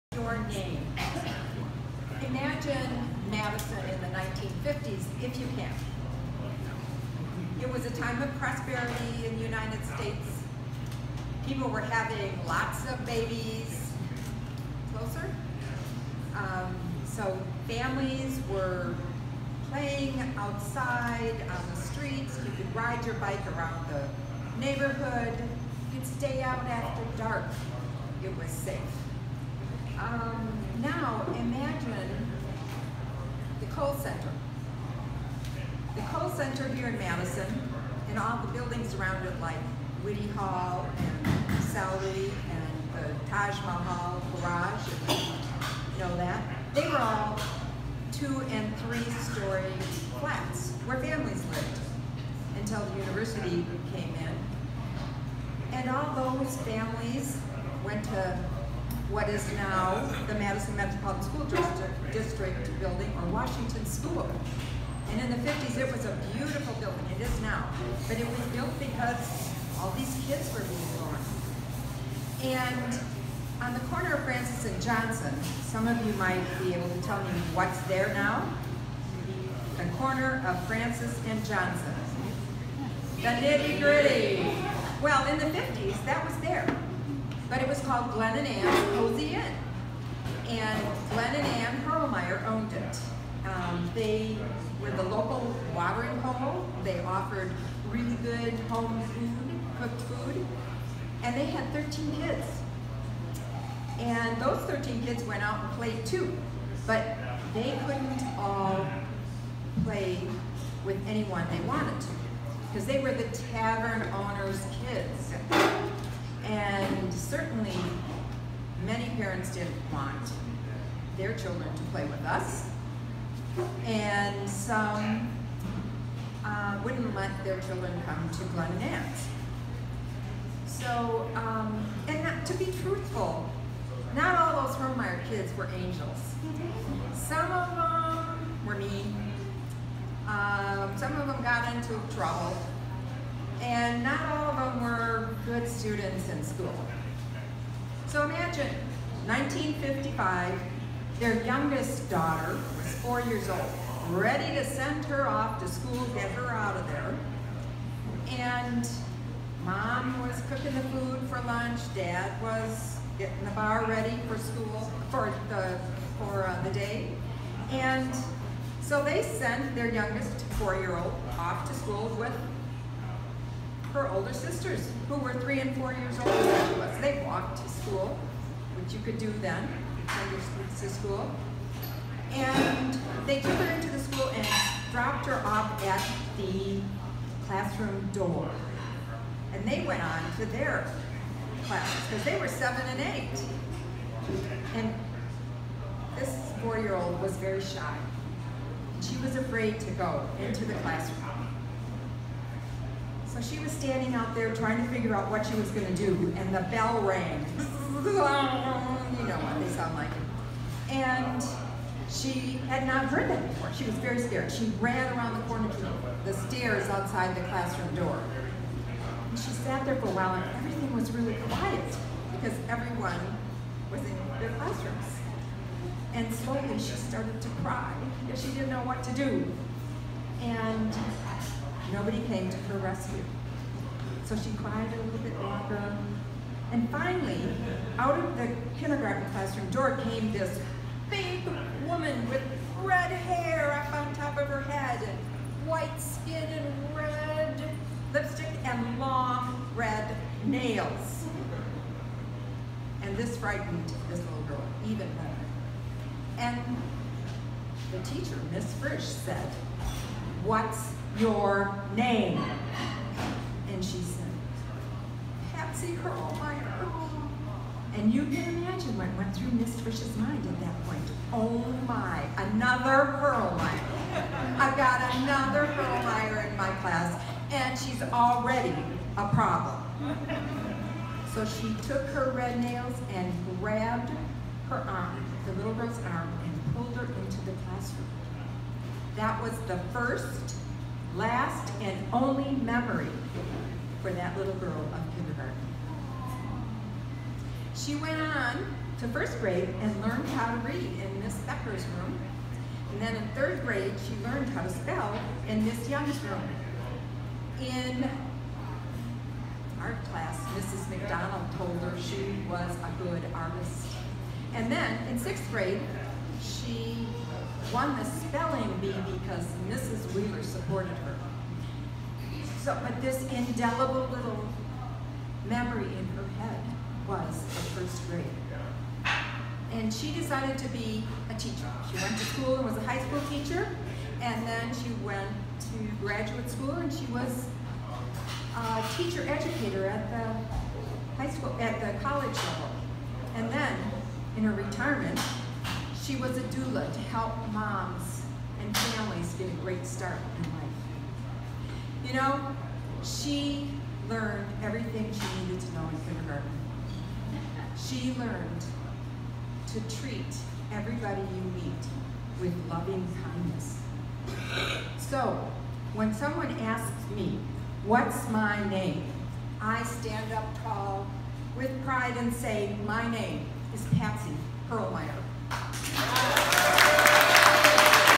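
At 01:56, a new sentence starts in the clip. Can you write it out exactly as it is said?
And certainly, many parents didn't want their children to play with us.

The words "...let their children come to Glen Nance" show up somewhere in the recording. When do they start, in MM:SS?
02:07.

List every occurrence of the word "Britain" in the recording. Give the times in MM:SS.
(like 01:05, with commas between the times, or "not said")
not said.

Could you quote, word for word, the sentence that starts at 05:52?
You know, she learned everything she needed to know in kindergarten.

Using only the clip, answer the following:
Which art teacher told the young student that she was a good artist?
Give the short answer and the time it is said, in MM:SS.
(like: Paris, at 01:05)
Mrs. McDonald, at 05:10.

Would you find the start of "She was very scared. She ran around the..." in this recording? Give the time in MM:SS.
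03:33.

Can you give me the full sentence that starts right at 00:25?
You could stay out after dark.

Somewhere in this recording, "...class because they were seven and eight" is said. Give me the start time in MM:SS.
03:11.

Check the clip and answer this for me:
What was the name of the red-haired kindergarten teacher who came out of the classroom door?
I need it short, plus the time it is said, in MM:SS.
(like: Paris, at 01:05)
Miss Frisch, at 04:18.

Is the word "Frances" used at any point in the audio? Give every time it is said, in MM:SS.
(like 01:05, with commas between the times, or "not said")
01:14, 01:20.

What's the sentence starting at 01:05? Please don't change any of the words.
And in the 50s, it was a beautiful building.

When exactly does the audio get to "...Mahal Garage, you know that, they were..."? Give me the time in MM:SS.
00:43.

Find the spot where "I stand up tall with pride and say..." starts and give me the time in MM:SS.
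06:09.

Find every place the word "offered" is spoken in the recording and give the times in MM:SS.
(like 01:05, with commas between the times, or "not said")
01:37.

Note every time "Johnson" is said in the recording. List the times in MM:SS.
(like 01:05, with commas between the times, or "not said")
01:14, 01:21.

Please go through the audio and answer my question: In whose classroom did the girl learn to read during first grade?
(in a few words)
Miss Becker.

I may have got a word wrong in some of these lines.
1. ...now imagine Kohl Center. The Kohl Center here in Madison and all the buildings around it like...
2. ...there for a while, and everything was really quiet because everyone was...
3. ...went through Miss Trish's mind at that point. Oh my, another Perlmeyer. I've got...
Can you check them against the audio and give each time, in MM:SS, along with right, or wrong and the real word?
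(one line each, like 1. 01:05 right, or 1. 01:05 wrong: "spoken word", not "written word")
1. 00:30 right
2. 03:39 right
3. 04:29 right.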